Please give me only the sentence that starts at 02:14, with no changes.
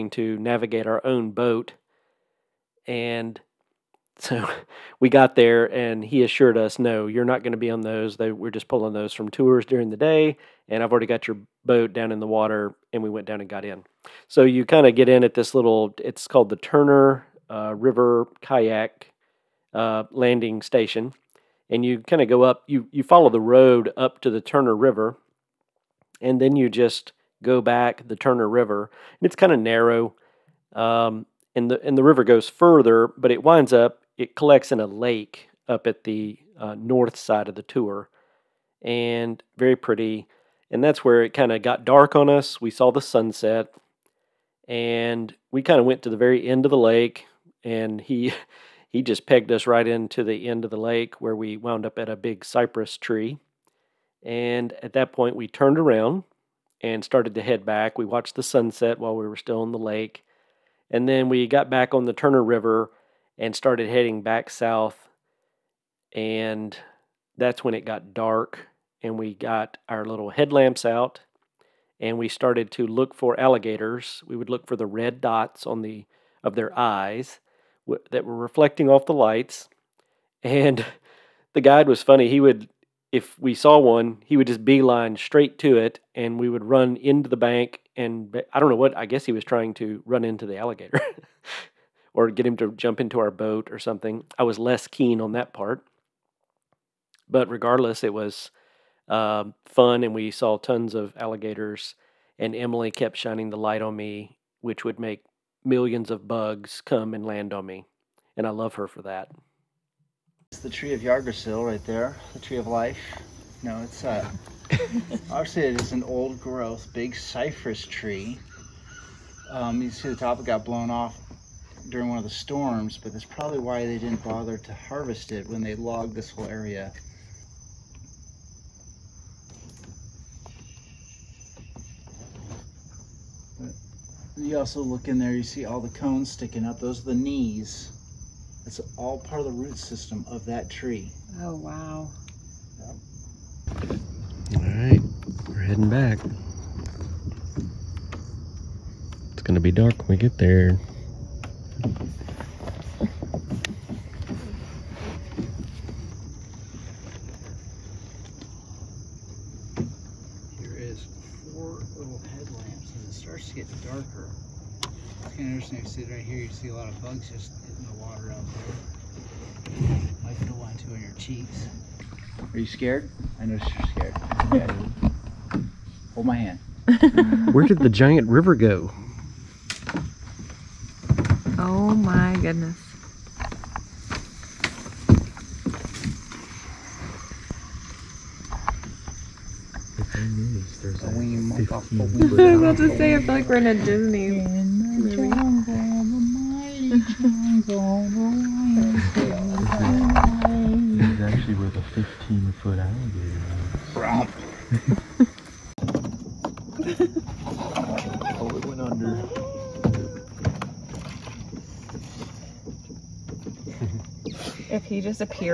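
you also look in there, you see all the cones sticking up.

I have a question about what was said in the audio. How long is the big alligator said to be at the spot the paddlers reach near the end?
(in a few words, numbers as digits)
15 foot.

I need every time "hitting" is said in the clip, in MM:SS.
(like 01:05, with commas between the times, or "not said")
02:47.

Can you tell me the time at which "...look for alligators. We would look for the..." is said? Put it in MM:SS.
01:12.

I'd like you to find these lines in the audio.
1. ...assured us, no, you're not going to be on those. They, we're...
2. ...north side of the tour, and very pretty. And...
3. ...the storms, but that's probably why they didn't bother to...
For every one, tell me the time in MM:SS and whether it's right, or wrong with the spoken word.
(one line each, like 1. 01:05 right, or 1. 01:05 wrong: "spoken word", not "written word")
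1. 00:06 right
2. 00:36 right
3. 02:02 right.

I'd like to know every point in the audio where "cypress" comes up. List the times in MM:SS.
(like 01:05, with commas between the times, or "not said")
00:52, 01:57.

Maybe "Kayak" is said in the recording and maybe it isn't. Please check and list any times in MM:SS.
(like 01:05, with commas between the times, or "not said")
00:18.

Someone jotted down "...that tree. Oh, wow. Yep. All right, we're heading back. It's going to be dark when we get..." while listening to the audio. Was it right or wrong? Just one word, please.
right.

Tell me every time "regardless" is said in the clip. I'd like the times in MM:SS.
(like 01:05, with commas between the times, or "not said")
01:37.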